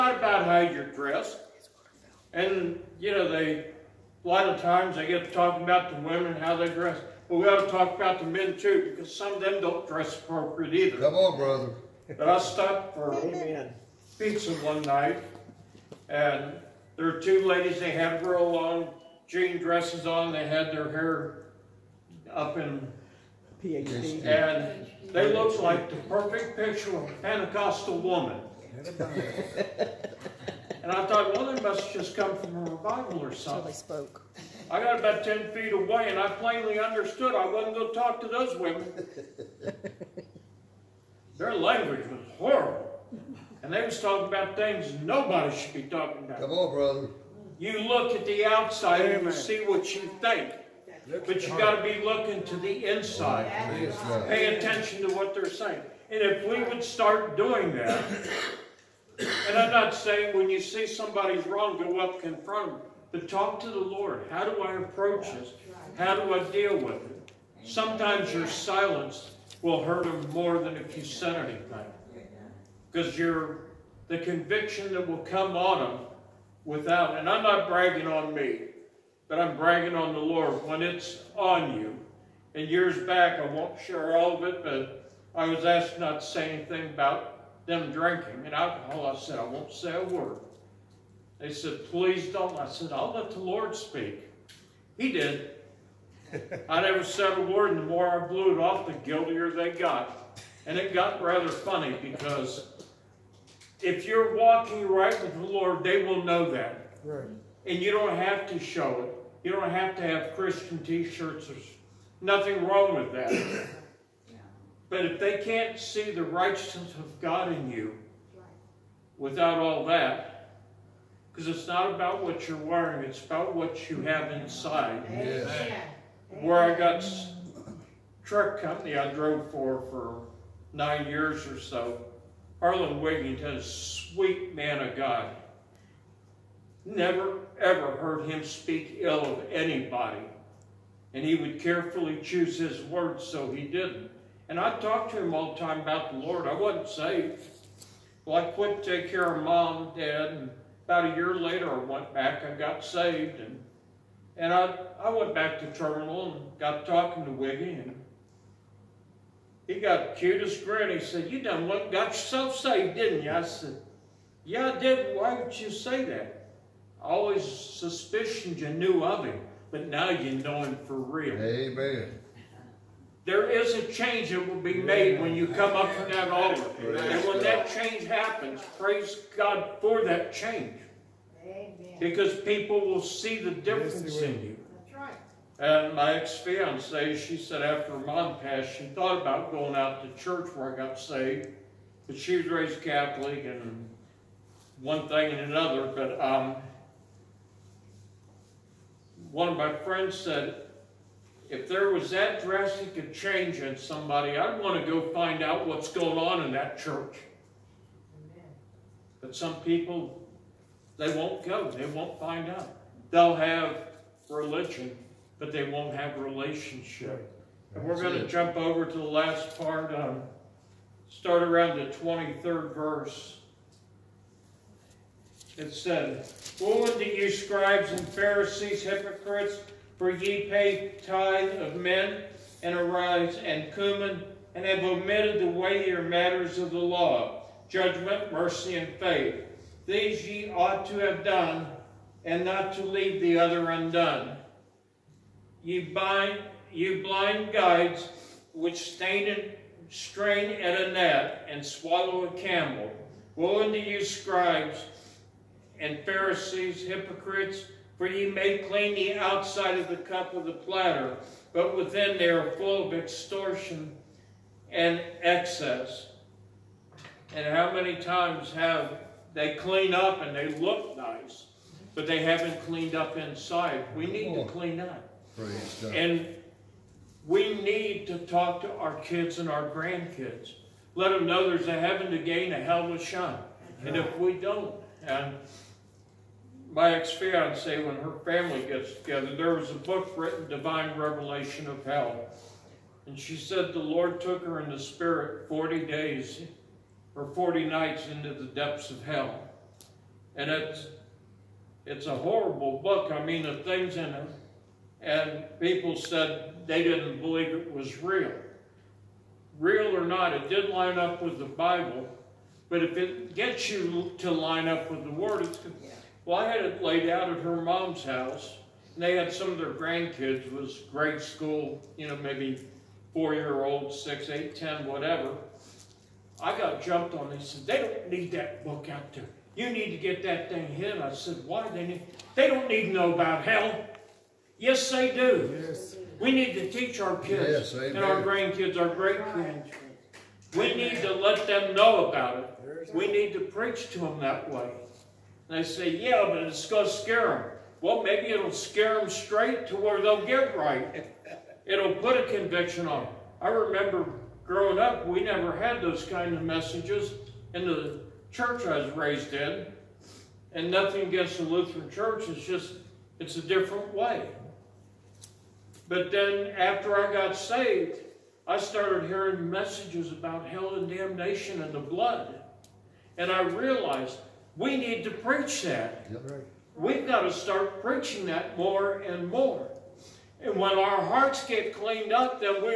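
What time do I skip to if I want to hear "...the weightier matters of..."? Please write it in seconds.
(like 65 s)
235 s.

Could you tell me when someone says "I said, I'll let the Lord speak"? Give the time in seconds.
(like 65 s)
92 s.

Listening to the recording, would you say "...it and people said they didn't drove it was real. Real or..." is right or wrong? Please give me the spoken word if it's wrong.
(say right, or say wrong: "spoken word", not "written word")
wrong: "believe", not "drove".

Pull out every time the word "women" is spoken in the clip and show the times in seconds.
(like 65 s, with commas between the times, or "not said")
6 s, 38 s.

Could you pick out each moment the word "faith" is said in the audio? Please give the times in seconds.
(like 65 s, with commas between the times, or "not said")
238 s.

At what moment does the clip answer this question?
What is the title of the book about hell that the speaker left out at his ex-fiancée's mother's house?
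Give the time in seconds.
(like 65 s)
290 s.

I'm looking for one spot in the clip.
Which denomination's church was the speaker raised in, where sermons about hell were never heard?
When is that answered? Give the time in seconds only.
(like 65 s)
361 s.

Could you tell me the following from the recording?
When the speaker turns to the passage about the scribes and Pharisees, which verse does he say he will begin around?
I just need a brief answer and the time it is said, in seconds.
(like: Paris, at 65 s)
23rd, at 221 s.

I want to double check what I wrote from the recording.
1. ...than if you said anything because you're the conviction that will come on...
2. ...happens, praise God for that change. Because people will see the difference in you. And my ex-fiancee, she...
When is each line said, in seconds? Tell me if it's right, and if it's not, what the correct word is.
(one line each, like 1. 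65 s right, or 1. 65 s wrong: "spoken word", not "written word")
1. 70 s right
2. 178 s right.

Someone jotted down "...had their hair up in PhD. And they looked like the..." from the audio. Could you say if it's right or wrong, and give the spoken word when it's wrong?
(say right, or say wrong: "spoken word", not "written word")
right.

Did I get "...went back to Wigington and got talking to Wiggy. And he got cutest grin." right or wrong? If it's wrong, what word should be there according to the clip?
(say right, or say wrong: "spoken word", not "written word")
wrong: "Terminal", not "Wigington".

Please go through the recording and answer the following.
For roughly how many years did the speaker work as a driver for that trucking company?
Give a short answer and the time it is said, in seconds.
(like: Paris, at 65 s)
9, at 130 s.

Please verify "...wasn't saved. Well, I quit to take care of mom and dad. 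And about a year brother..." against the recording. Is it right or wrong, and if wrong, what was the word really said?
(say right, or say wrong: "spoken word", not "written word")
wrong: "later", not "brother".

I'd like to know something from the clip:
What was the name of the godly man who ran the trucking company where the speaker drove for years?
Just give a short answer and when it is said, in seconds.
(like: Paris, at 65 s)
Harlan Wigington, at 132 s.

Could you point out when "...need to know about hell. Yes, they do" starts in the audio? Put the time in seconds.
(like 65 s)
332 s.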